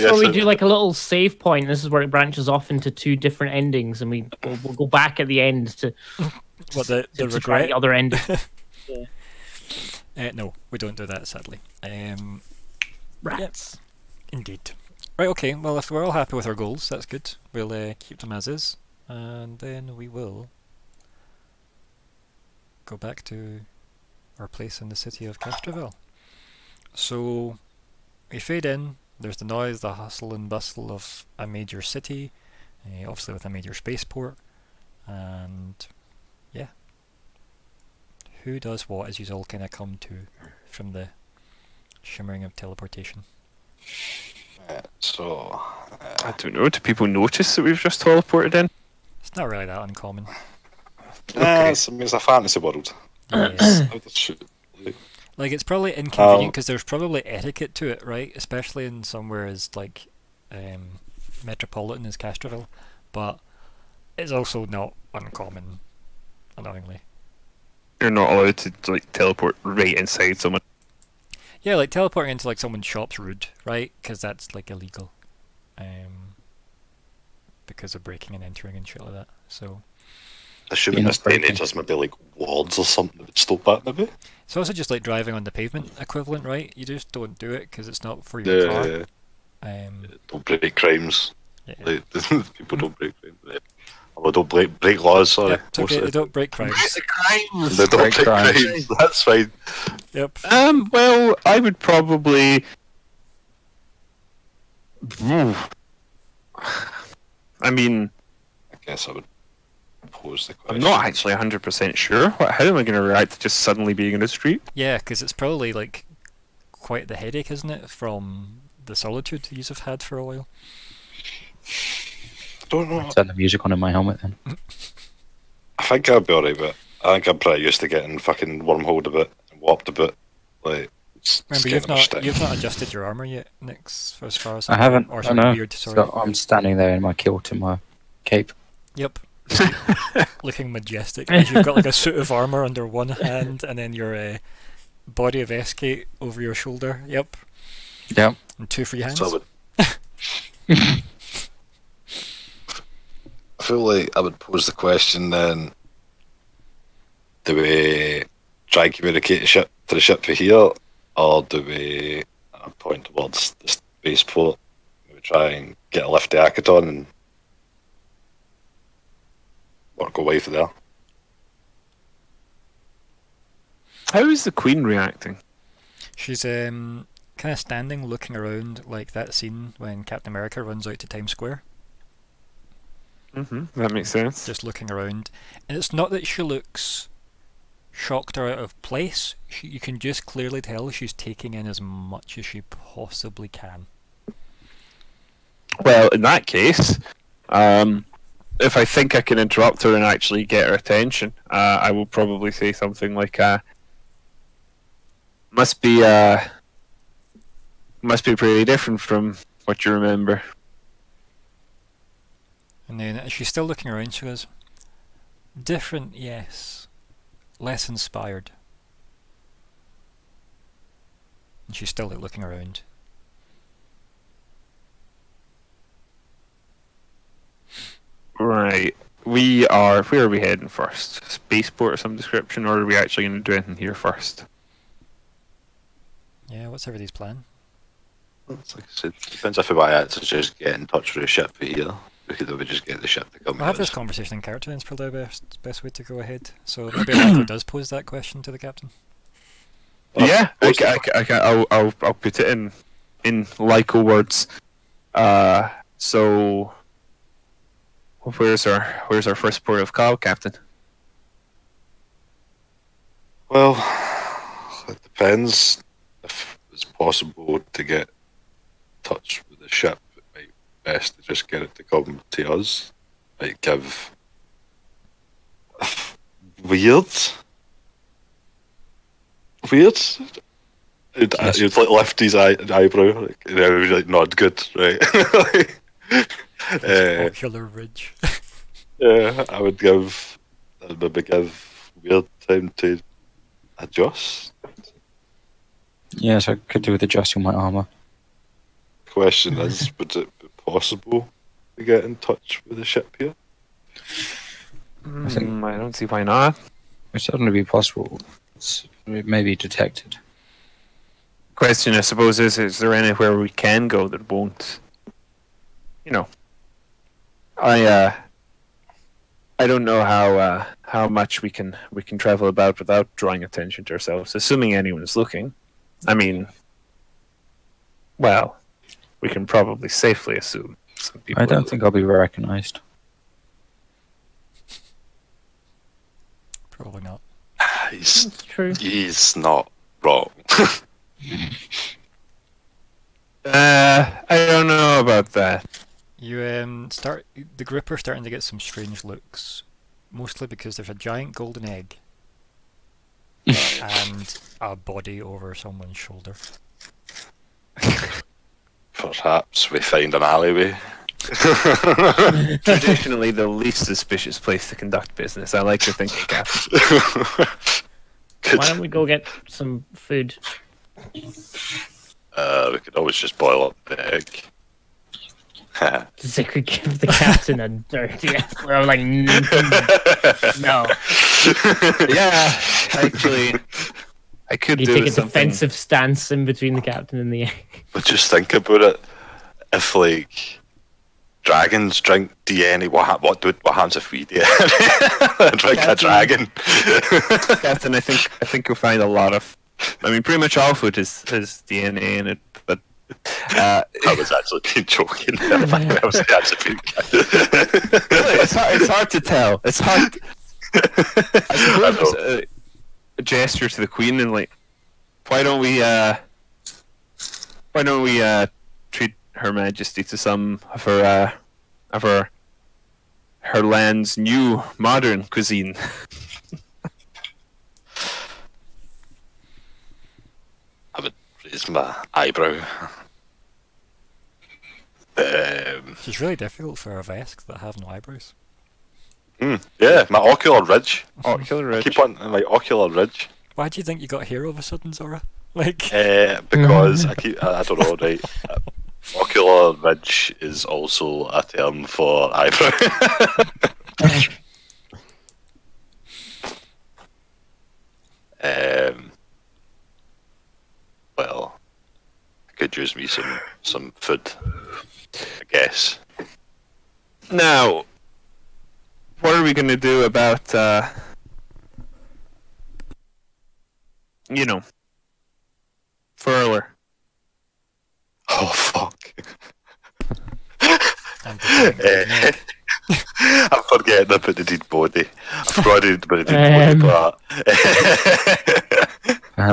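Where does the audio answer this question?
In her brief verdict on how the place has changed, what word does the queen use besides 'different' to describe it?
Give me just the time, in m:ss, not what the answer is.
3:37.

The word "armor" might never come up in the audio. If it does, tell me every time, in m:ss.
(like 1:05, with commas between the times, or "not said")
2:13, 2:22, 4:57.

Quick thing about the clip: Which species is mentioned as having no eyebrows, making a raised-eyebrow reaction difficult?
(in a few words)
Vesk.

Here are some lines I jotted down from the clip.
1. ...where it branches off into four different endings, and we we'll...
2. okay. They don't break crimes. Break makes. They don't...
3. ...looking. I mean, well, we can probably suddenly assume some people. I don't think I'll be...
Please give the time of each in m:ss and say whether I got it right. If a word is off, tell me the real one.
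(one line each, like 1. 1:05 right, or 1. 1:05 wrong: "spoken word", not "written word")
1. 0:01 wrong: "two", not "four"
2. 1:35 wrong: "crimes", not "makes"
3. 5:25 wrong: "safely", not "suddenly".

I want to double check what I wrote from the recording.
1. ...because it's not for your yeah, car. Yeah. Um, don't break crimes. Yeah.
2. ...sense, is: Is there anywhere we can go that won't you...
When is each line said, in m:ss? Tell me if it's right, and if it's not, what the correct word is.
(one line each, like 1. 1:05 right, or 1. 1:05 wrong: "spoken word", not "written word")
1. 1:27 right
2. 5:12 wrong: "suppose", not "sense".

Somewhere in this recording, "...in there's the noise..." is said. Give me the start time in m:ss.
0:28.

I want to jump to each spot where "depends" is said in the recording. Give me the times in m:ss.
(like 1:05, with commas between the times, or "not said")
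3:59, 4:25.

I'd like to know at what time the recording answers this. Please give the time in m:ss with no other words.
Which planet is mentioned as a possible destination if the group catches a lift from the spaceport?
2:46.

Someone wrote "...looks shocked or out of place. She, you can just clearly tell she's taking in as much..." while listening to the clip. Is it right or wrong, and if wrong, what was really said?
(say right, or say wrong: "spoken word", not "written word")
right.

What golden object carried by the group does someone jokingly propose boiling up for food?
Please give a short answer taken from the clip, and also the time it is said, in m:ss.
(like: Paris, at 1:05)
The egg, at 6:13.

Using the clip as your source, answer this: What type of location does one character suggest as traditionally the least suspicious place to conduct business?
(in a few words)
An alleyway.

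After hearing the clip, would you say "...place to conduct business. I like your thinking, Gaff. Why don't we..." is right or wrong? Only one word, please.
right.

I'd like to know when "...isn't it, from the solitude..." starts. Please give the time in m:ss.
1:57.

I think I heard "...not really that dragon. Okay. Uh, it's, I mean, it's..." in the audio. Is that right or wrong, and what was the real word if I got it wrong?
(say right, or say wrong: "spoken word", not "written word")
wrong: "uncommon", not "dragon".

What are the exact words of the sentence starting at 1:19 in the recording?
So Assuming this day and age, there's maybe like wards or something that would stop that, maybe.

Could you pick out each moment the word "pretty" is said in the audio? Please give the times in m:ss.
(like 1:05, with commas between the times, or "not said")
2:07, 3:28, 6:40.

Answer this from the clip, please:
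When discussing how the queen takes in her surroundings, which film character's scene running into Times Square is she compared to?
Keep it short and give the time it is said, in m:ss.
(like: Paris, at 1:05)
Captain America, at 3:00.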